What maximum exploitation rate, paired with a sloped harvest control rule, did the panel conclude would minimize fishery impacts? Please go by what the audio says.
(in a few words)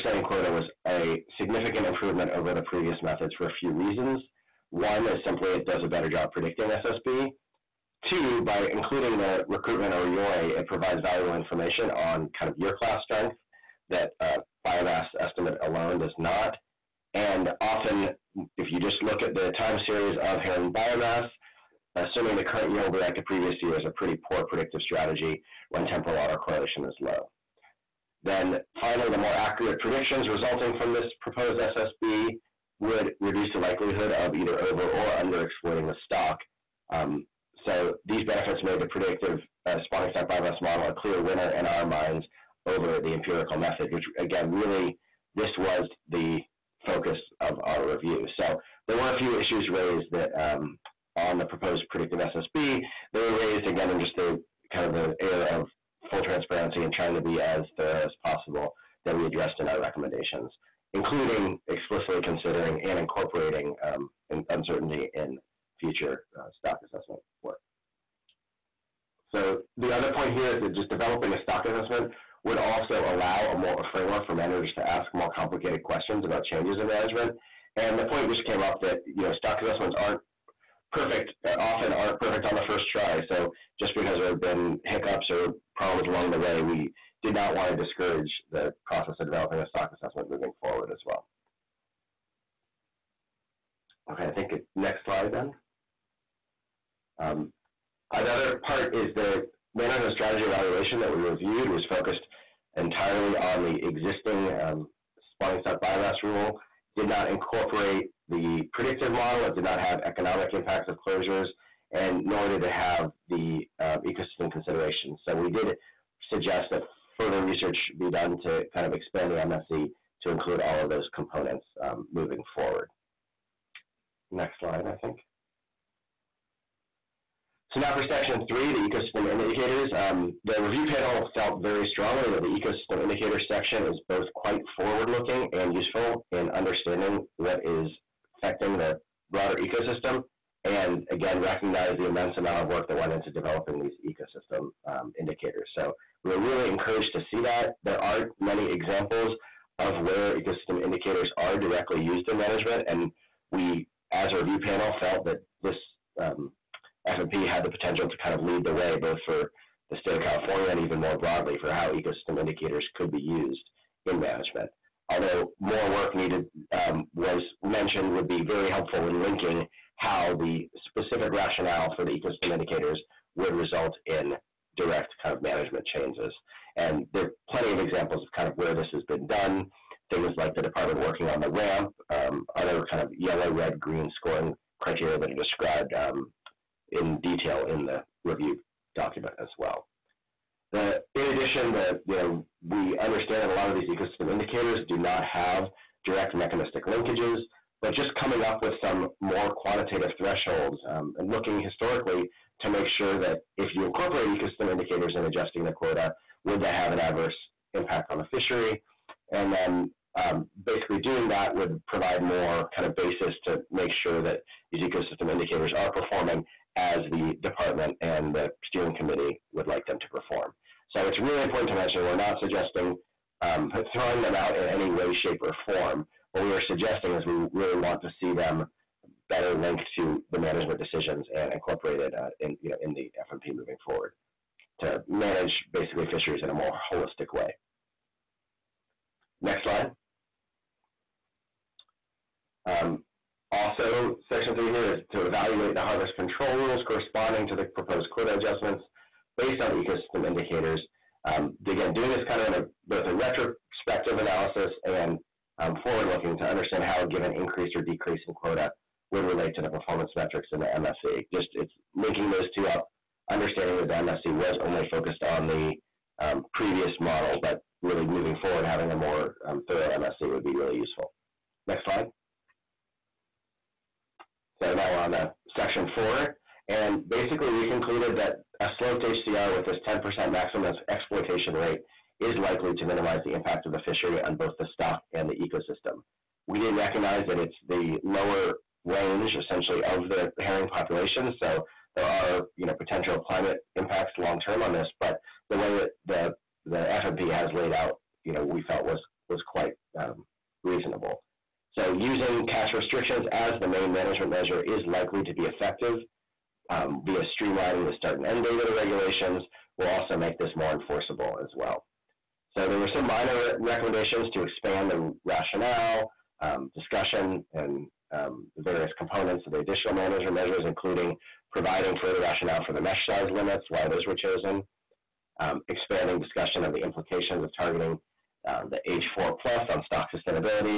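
10%.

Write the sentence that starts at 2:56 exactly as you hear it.
And there are plenty of examples of kind of where this has been done.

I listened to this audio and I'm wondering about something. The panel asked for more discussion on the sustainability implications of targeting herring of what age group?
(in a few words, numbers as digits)
age 4 plus.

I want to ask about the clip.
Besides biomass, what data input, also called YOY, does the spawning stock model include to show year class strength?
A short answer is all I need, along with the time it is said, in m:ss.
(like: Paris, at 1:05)
recruitment, at 0:09.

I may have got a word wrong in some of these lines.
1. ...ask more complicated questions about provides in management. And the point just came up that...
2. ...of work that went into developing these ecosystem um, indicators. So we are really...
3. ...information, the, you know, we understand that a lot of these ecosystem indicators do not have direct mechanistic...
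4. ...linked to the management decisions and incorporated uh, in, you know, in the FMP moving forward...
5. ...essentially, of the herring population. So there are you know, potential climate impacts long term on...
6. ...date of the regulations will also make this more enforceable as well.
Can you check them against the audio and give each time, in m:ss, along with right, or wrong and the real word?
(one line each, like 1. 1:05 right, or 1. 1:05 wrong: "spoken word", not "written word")
1. 1:14 wrong: "changes", not "provides"
2. 2:22 right
3. 3:11 wrong: "addition", not "information"
4. 3:49 right
5. 4:49 right
6. 5:08 right.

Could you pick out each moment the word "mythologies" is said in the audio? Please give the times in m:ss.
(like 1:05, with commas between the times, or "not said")
not said.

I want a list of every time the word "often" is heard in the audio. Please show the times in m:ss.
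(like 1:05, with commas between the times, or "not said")
0:17, 1:21.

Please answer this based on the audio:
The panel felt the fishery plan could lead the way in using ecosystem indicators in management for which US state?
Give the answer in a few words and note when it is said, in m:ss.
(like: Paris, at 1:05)
California, at 2:40.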